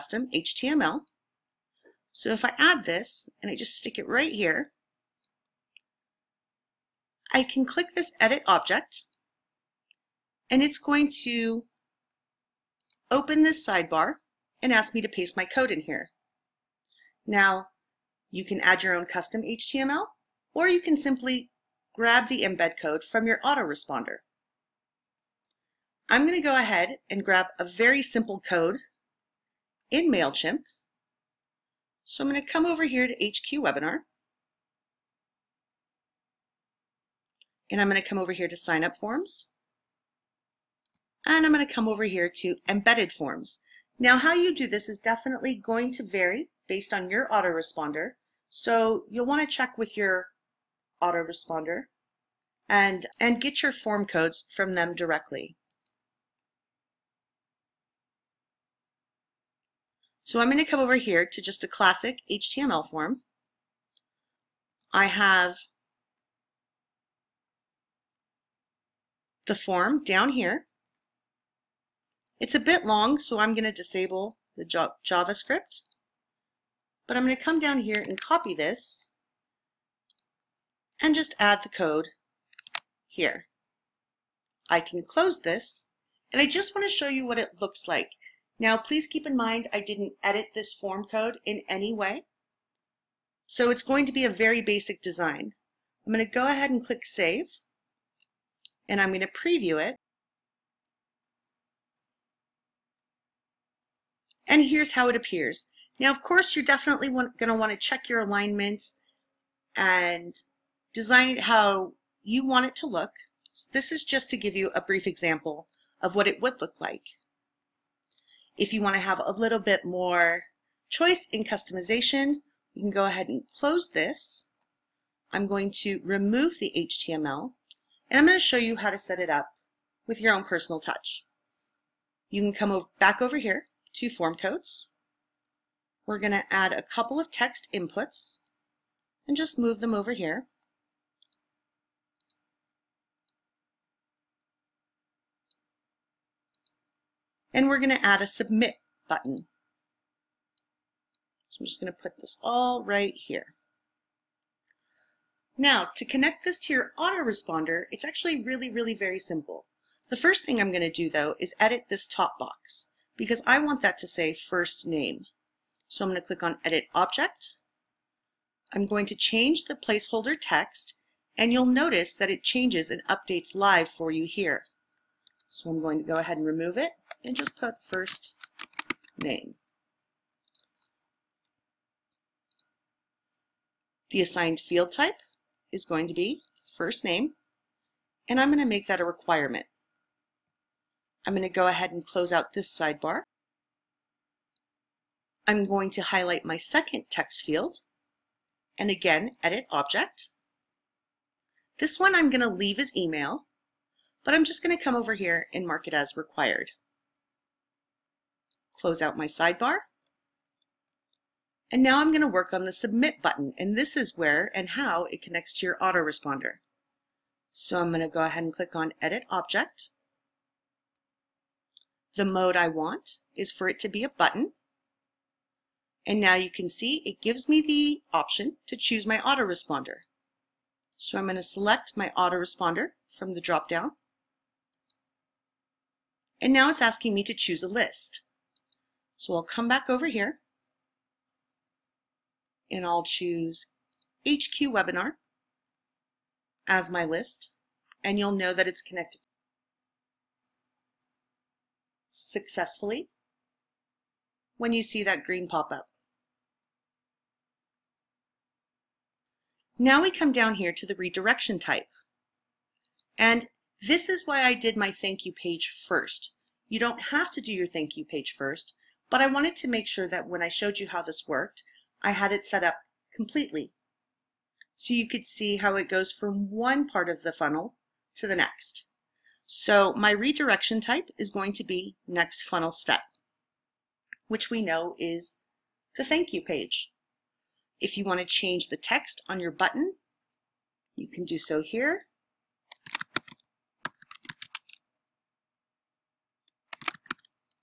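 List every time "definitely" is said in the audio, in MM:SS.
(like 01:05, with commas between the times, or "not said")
00:44, 01:46.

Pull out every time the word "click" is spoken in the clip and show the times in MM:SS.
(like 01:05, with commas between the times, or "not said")
00:07, 01:36, 02:46, 03:38.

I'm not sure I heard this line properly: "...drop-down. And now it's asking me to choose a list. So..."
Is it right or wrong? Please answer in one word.
right.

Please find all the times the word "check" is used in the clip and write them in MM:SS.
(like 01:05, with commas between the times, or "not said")
00:49, 01:47.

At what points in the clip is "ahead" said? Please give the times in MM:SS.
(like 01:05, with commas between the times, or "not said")
00:26, 01:36, 02:03, 02:56, 03:11, 03:38.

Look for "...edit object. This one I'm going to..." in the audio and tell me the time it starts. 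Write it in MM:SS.
03:19.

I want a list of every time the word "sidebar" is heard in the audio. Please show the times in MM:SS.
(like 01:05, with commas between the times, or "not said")
00:13, 03:12, 03:29.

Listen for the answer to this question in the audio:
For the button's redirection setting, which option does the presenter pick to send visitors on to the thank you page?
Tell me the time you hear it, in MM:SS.
04:42.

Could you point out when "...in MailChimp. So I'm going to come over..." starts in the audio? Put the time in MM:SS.
00:29.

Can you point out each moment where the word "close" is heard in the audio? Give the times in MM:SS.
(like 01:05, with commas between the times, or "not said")
01:25, 02:03, 03:12, 03:28.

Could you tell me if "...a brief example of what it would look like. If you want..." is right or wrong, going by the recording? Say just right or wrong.
right.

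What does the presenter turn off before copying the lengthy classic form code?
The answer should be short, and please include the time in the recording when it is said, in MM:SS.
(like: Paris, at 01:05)
The JavaScript, at 01:14.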